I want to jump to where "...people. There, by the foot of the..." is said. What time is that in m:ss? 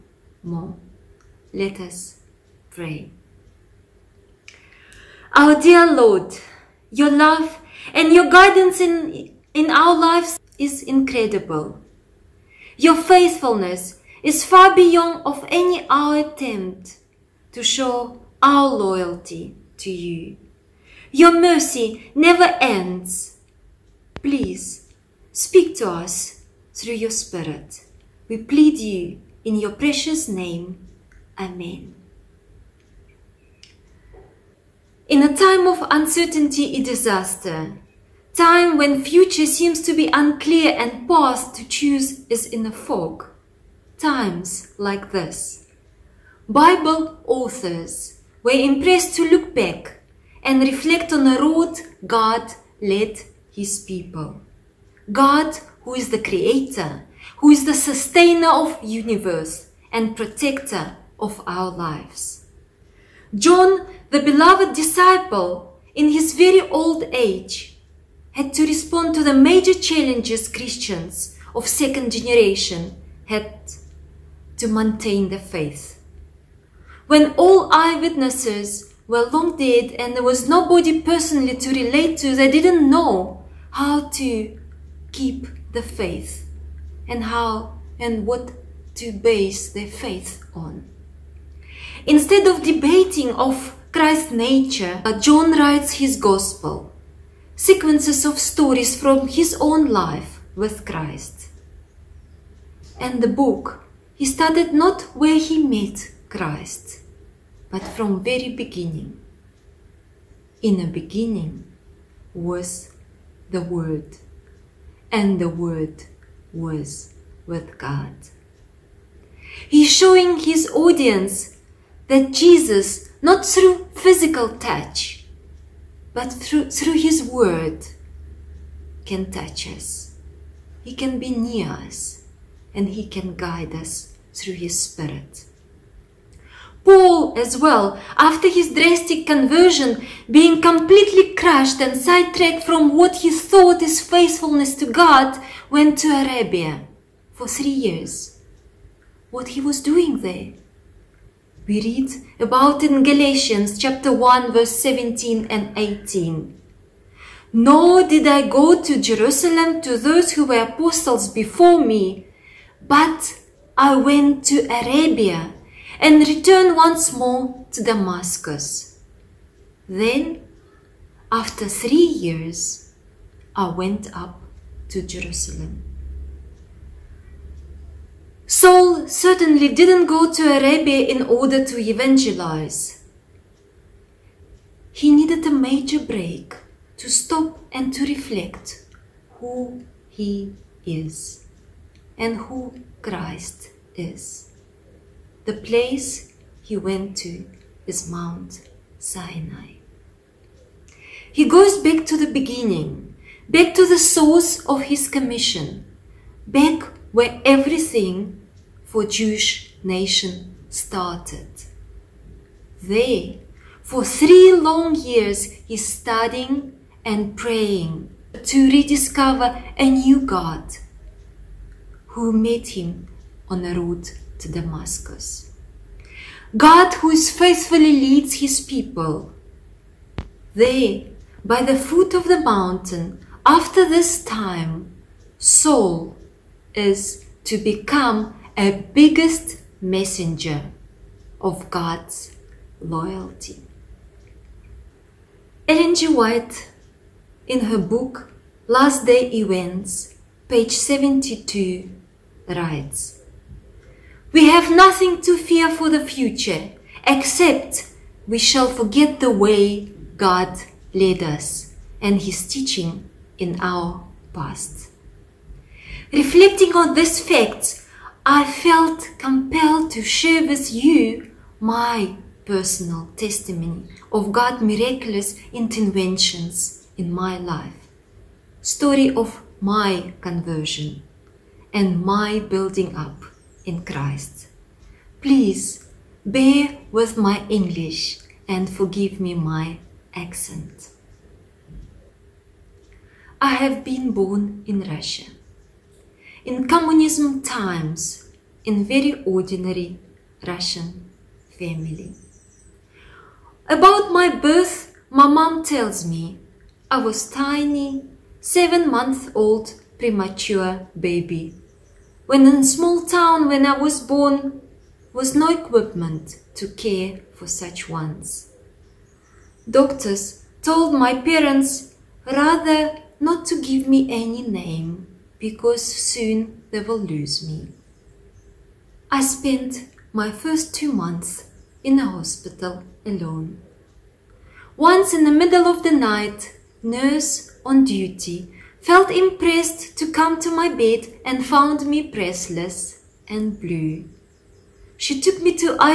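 3:48.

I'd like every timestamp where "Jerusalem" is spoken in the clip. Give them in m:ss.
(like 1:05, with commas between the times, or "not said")
2:38, 2:55.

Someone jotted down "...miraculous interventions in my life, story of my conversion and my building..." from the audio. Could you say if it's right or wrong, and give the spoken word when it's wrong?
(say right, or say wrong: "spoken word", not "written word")
right.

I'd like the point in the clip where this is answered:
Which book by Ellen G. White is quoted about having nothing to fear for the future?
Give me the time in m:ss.
4:08.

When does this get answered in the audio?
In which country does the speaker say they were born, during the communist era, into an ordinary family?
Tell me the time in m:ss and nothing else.
4:54.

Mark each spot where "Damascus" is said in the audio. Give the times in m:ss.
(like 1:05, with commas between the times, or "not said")
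2:47, 3:44.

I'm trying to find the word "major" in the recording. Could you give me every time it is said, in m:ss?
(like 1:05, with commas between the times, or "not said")
1:09, 3:05.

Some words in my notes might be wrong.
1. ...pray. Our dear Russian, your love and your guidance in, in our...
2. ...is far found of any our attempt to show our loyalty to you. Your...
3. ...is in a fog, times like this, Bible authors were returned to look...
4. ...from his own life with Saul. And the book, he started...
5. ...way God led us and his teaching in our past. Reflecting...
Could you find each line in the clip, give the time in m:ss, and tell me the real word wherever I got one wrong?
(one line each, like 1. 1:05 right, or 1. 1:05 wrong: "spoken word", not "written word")
1. 0:02 wrong: "Lord", not "Russian"
2. 0:14 wrong: "beyond", not "found"
3. 0:42 wrong: "impressed", not "returned"
4. 1:38 wrong: "Christ", not "Saul"
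5. 4:19 right.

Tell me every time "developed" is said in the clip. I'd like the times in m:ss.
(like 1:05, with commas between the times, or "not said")
not said.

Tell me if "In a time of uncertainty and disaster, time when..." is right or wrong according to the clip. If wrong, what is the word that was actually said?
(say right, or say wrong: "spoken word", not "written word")
right.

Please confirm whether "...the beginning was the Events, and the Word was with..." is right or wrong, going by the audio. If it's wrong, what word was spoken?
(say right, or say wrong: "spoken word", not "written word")
wrong: "Word", not "Events".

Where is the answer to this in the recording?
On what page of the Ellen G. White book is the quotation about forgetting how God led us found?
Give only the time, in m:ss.
4:10.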